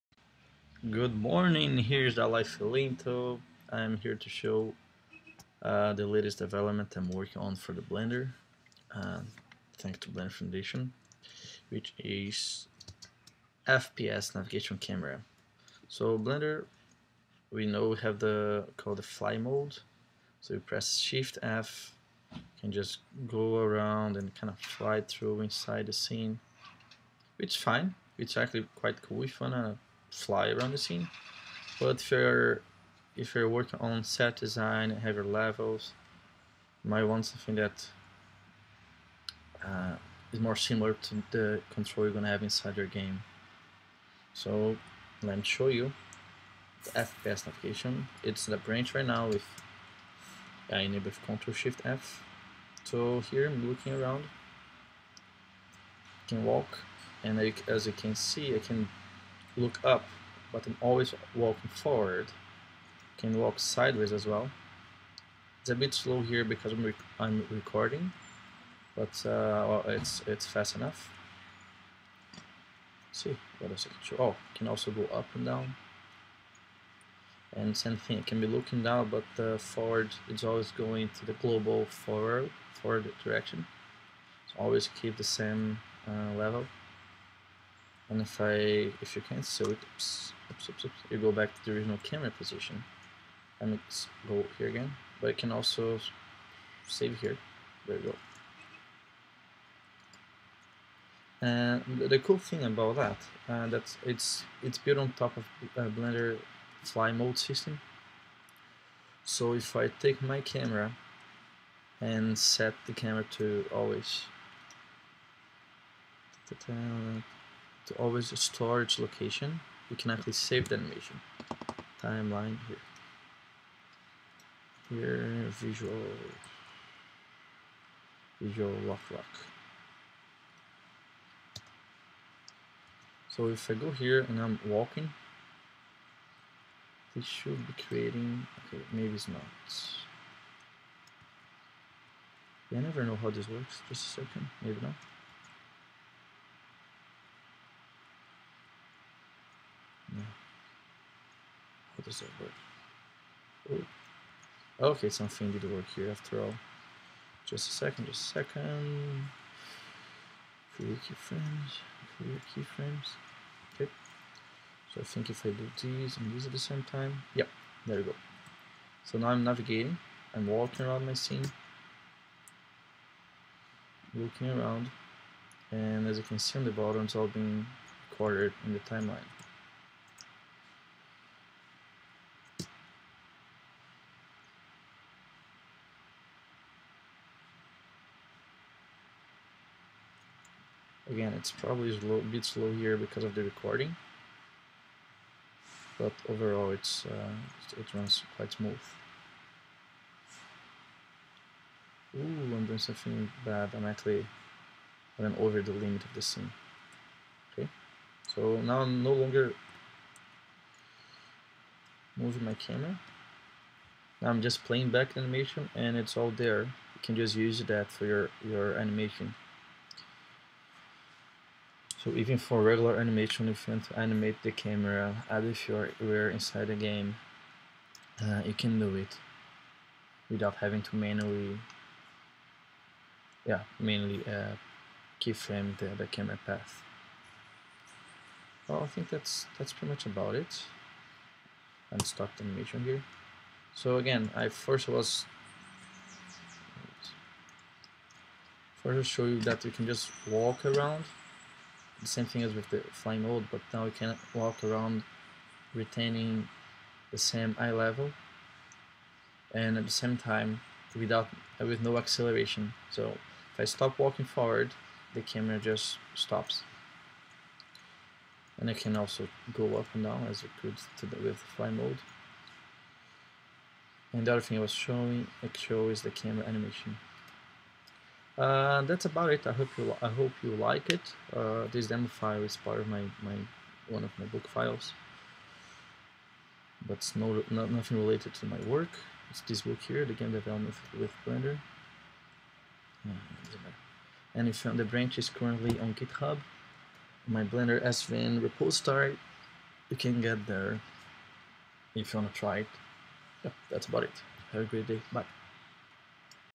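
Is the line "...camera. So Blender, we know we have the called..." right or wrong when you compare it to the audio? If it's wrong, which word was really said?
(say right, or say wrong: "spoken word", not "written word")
right.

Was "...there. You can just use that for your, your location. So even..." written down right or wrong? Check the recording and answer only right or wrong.
wrong.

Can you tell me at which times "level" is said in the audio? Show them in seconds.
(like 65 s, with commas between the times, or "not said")
35 s, 86 s, 257 s.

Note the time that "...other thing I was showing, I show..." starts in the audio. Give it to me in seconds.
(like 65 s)
274 s.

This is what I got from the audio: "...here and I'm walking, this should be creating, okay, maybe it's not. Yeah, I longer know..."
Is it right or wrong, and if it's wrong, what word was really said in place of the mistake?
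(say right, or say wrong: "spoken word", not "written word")
wrong: "never", not "longer".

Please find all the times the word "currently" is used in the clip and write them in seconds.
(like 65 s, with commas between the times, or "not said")
295 s.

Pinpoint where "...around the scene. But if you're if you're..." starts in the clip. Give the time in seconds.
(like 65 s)
30 s.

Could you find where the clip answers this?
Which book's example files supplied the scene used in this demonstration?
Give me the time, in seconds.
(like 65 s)
290 s.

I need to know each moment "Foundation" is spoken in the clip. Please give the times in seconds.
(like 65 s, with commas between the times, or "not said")
10 s.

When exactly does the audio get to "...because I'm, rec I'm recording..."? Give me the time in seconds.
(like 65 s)
66 s.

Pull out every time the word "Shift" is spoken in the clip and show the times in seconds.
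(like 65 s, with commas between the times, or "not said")
20 s, 51 s.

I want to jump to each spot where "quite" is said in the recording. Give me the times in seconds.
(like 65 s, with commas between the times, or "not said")
28 s, 198 s.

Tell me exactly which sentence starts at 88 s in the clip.
And if I, if you see it, oops, oops, oops, oops, you go back to the original camera position.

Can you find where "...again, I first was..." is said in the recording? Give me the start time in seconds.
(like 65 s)
243 s.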